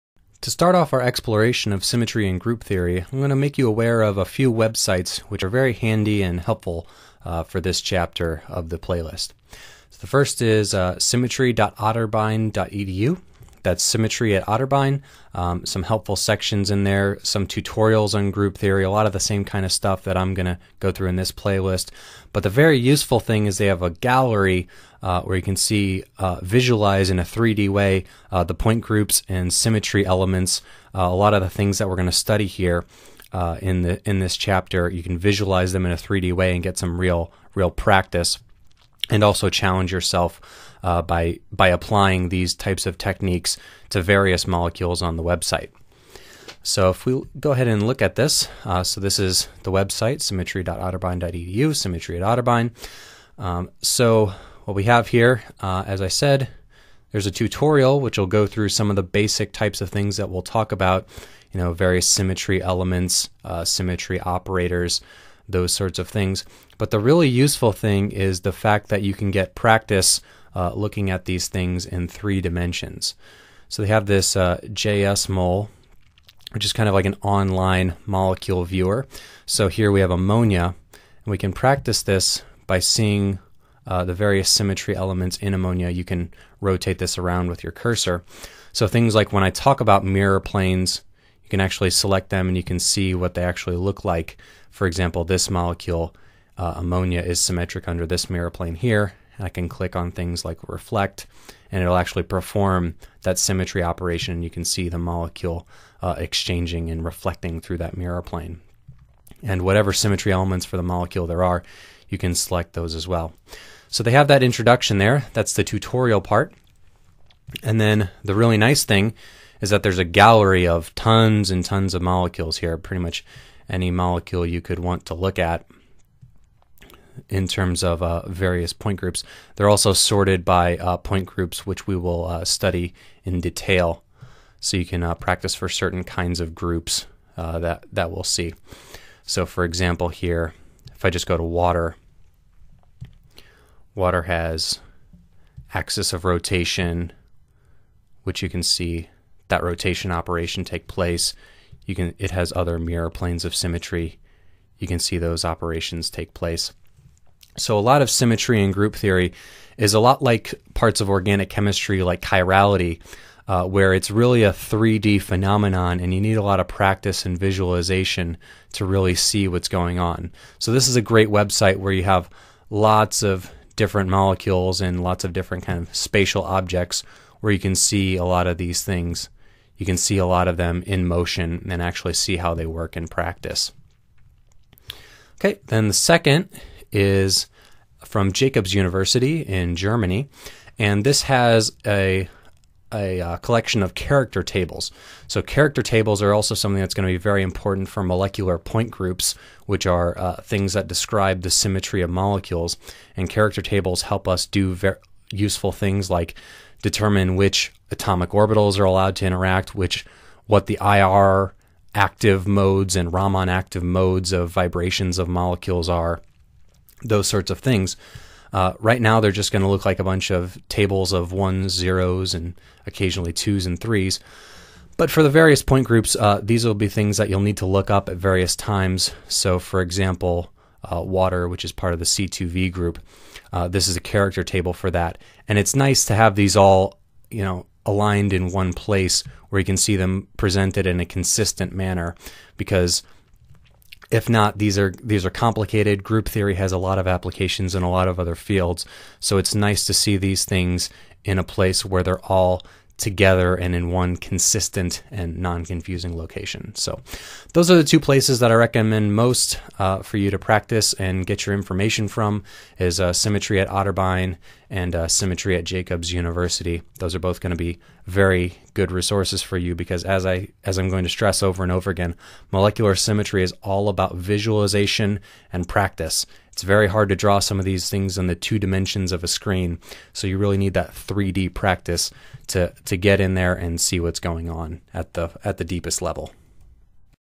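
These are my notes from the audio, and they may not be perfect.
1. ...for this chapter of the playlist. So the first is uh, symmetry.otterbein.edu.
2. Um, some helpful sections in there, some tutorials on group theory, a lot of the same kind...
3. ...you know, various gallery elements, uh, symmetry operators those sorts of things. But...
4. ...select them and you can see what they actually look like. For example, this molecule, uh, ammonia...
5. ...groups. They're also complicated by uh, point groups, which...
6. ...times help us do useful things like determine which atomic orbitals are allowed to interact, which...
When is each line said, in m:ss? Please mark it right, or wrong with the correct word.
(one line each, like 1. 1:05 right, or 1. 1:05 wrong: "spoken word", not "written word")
1. 0:07 right
2. 0:15 right
3. 1:01 wrong: "symmetry", not "gallery"
4. 1:31 right
5. 2:08 wrong: "sorted", not "complicated"
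6. 3:23 wrong: "tables", not "times".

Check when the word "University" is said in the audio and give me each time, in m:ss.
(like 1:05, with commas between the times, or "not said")
3:08, 4:26.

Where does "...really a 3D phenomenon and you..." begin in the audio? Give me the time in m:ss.
2:44.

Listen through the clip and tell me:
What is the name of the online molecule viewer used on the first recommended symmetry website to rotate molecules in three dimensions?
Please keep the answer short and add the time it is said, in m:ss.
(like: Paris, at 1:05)
JSmol, at 1:14.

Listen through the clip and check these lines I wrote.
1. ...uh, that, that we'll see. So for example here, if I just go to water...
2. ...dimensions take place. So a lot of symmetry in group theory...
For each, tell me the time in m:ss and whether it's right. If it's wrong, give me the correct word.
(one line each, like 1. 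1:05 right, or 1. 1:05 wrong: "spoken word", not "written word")
1. 2:17 right
2. 2:35 wrong: "operations", not "dimensions".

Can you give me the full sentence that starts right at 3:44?
But for the various point groups, uh, these will be things that you'll need to look up at various times.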